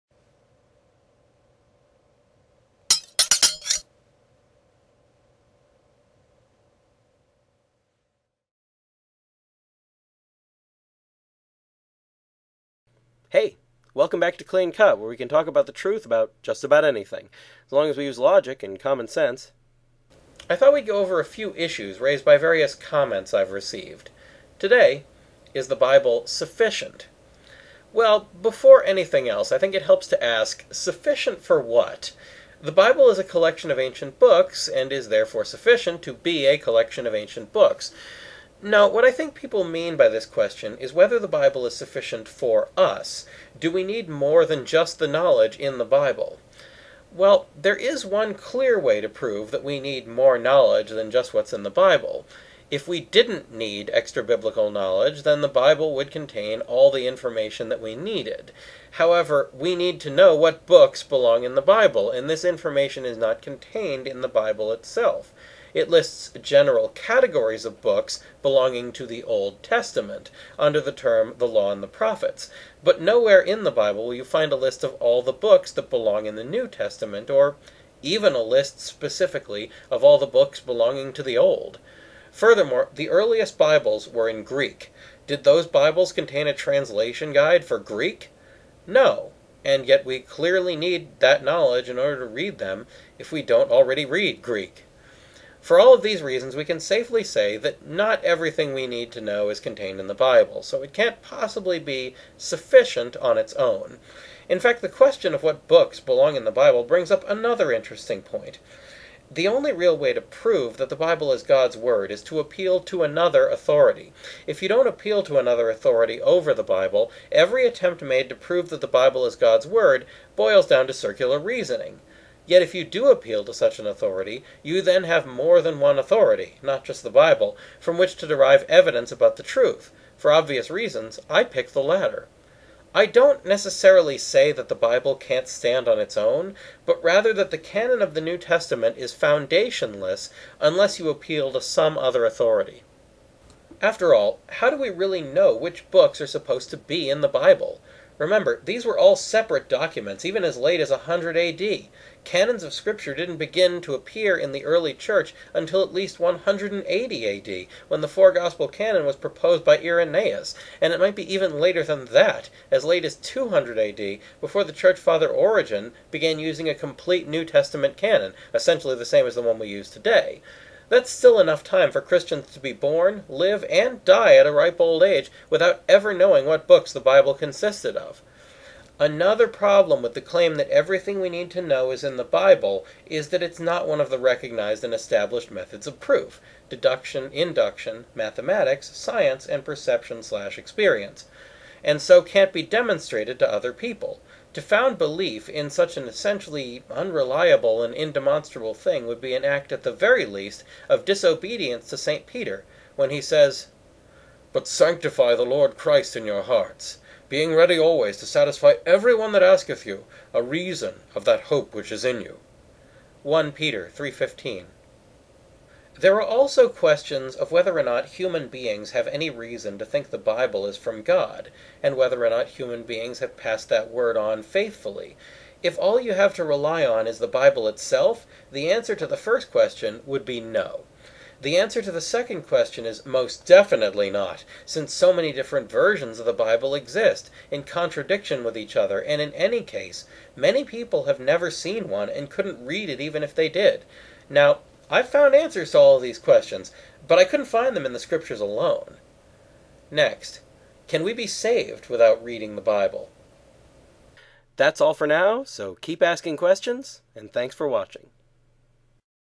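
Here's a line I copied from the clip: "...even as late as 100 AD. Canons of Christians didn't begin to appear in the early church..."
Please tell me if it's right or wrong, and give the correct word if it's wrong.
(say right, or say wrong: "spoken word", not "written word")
wrong: "Scripture", not "Christians".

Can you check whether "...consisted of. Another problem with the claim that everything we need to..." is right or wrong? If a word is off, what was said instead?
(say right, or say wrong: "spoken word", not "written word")
right.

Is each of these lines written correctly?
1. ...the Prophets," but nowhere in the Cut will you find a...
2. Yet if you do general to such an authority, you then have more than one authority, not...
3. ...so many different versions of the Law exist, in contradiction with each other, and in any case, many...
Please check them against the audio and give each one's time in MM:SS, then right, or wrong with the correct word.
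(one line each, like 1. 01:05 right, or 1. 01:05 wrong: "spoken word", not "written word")
1. 01:11 wrong: "Bible", not "Cut"
2. 02:02 wrong: "appeal", not "general"
3. 03:54 wrong: "Bible", not "Law".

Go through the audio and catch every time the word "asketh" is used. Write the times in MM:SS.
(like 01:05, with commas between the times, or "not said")
03:29.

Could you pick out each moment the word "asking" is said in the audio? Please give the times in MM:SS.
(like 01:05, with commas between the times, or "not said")
04:16.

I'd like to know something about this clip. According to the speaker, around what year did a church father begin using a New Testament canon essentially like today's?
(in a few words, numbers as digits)
200 AD.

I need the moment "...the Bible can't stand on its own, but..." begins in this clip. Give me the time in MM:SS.
02:14.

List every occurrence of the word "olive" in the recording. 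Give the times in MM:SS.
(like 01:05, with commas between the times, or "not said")
not said.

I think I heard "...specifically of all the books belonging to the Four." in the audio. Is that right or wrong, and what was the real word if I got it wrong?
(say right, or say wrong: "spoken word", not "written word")
wrong: "Old", not "Four".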